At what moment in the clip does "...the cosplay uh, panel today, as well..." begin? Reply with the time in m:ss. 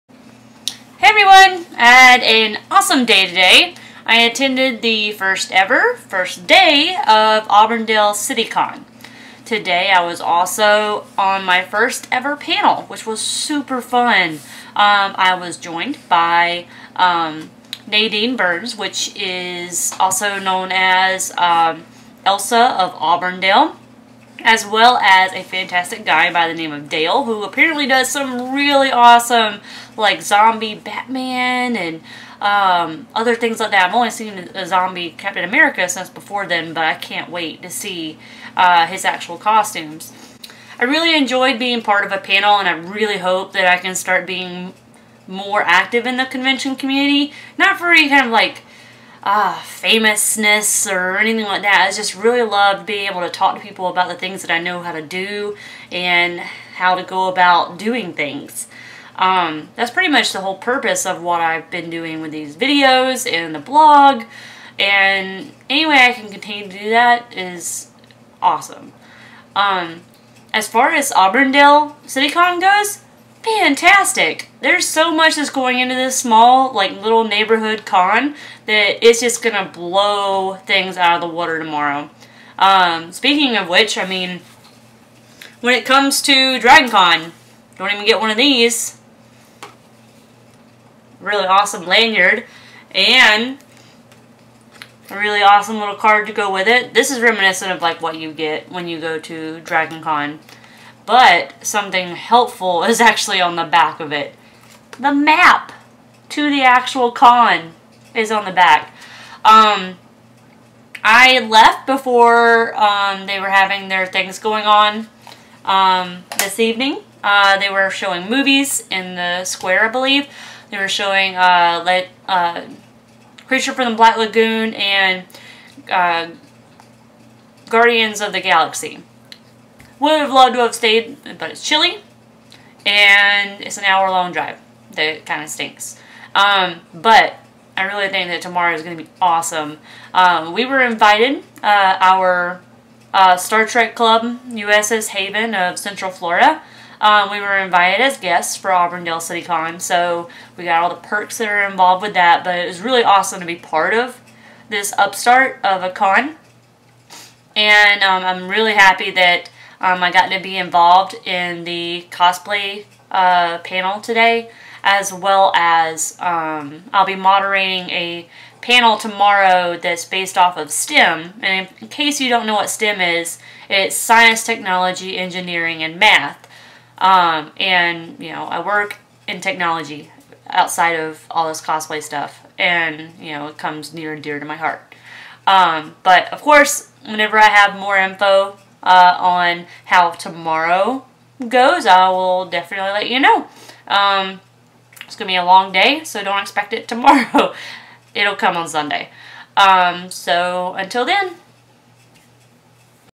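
2:41.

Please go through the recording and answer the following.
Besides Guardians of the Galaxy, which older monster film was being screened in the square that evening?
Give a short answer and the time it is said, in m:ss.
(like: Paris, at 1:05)
Creature from the Black Lagoon, at 2:03.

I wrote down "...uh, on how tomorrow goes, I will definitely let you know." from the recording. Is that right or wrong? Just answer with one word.
right.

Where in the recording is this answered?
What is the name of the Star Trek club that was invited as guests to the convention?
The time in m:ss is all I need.
2:24.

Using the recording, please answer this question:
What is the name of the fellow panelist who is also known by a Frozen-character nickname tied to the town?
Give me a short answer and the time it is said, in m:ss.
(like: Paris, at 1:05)
Nadine Burns, at 0:17.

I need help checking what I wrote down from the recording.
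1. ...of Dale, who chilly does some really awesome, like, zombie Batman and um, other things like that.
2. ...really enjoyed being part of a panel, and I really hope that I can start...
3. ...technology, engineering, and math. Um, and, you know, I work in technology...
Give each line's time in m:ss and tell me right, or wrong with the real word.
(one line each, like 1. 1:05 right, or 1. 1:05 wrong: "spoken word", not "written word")
1. 0:26 wrong: "apparently", not "chilly"
2. 0:40 right
3. 2:54 right.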